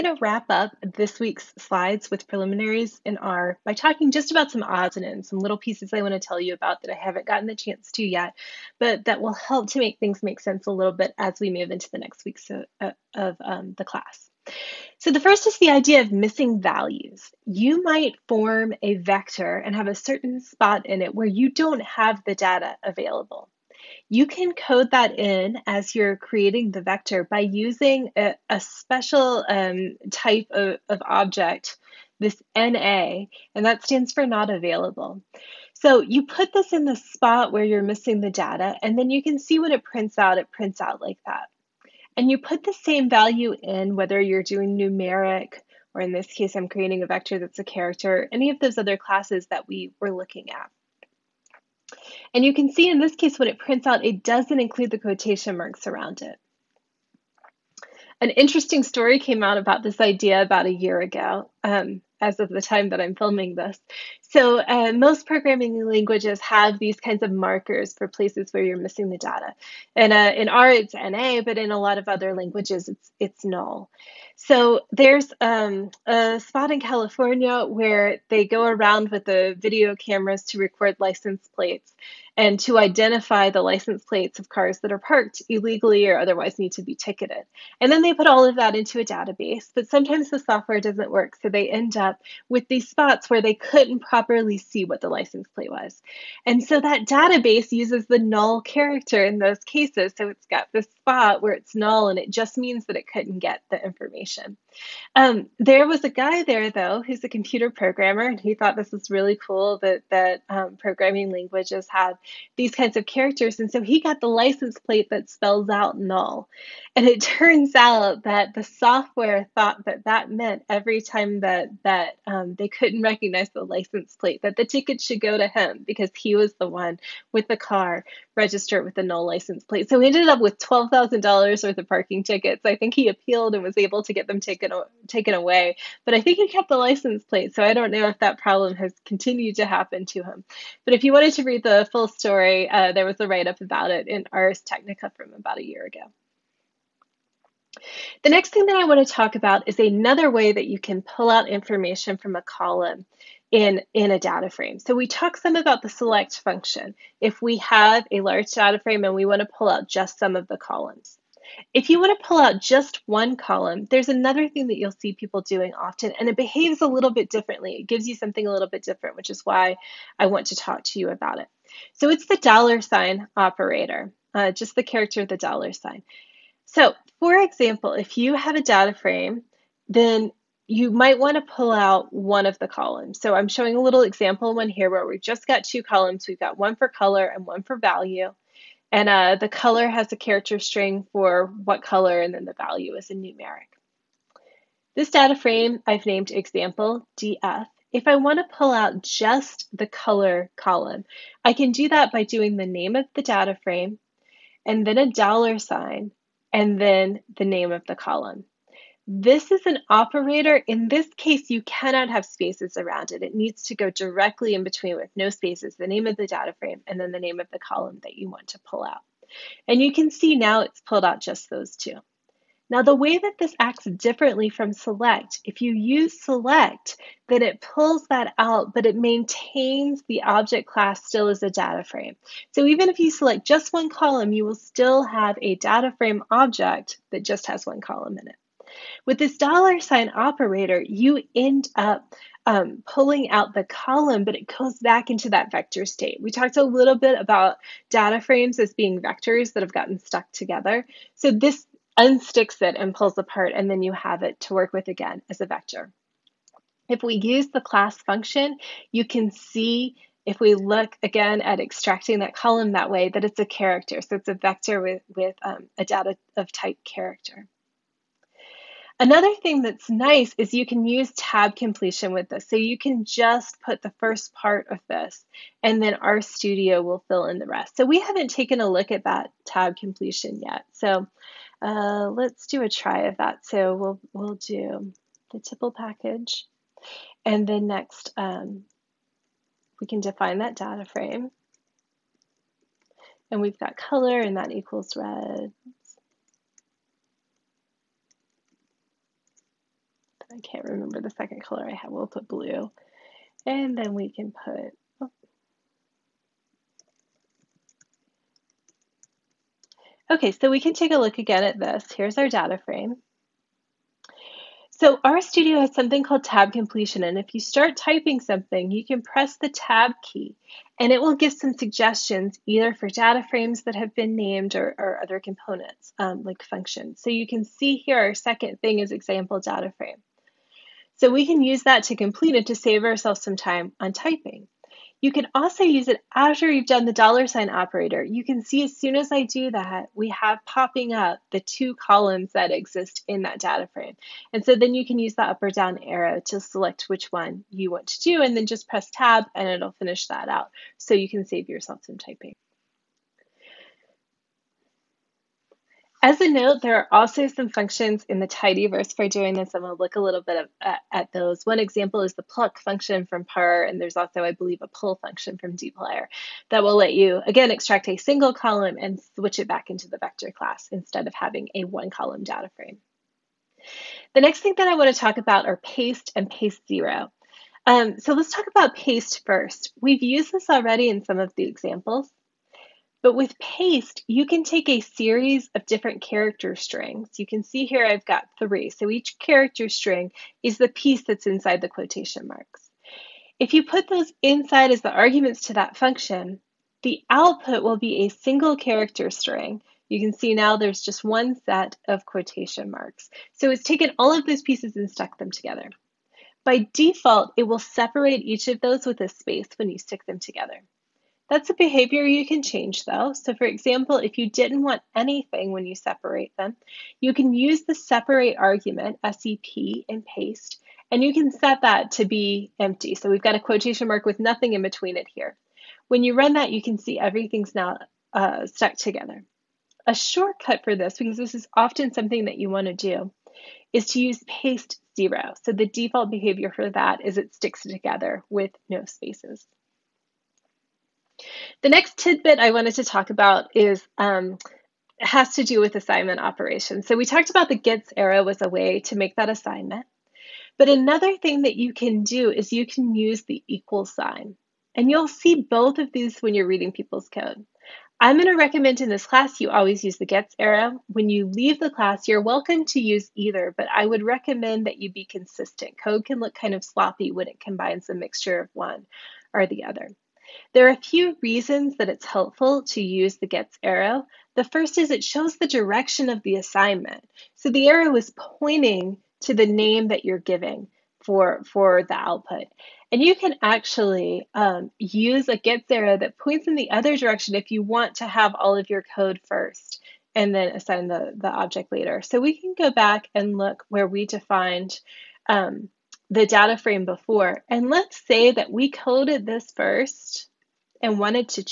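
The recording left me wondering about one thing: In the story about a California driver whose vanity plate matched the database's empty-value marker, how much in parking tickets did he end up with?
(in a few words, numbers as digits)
$12,000.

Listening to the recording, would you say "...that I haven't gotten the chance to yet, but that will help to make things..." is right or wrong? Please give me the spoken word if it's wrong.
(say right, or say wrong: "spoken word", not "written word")
right.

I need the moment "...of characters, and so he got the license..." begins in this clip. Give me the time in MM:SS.
01:52.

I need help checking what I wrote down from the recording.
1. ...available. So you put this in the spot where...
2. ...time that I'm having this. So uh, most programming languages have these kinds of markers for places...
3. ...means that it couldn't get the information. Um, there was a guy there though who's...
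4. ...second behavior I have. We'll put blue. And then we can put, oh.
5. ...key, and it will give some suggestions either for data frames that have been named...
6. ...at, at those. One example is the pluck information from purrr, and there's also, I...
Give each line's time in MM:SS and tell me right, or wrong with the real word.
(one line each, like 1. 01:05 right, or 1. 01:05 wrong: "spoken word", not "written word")
1. 00:34 right
2. 01:02 wrong: "filming", not "having"
3. 01:42 right
4. 05:01 wrong: "color", not "behavior"
5. 05:20 right
6. 06:00 wrong: "function", not "information".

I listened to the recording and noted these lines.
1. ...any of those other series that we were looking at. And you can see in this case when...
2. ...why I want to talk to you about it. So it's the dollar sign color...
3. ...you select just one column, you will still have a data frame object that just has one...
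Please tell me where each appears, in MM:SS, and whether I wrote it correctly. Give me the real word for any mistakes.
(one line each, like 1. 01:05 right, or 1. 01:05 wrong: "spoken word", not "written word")
1. 00:48 wrong: "classes", not "series"
2. 02:49 wrong: "operator", not "color"
3. 03:52 right.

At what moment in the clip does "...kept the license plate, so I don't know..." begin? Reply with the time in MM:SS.
02:16.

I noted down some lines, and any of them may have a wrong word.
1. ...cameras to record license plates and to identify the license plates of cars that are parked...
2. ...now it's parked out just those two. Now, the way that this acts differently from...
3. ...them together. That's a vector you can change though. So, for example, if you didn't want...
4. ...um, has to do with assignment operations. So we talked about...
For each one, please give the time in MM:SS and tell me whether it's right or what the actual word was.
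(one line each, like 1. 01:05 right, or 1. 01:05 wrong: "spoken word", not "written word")
1. 01:19 right
2. 03:40 wrong: "pulled", not "parked"
3. 06:50 wrong: "behavior", not "vector"
4. 07:23 right.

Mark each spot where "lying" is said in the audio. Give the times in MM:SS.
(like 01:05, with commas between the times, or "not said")
not said.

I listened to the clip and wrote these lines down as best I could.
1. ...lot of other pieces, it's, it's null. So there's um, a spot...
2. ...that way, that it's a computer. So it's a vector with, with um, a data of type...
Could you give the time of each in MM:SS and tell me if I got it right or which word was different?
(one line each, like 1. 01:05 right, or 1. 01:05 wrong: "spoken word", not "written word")
1. 01:11 wrong: "languages", not "pieces"
2. 04:22 wrong: "character", not "computer".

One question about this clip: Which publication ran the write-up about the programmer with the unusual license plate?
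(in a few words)
Ars Technica.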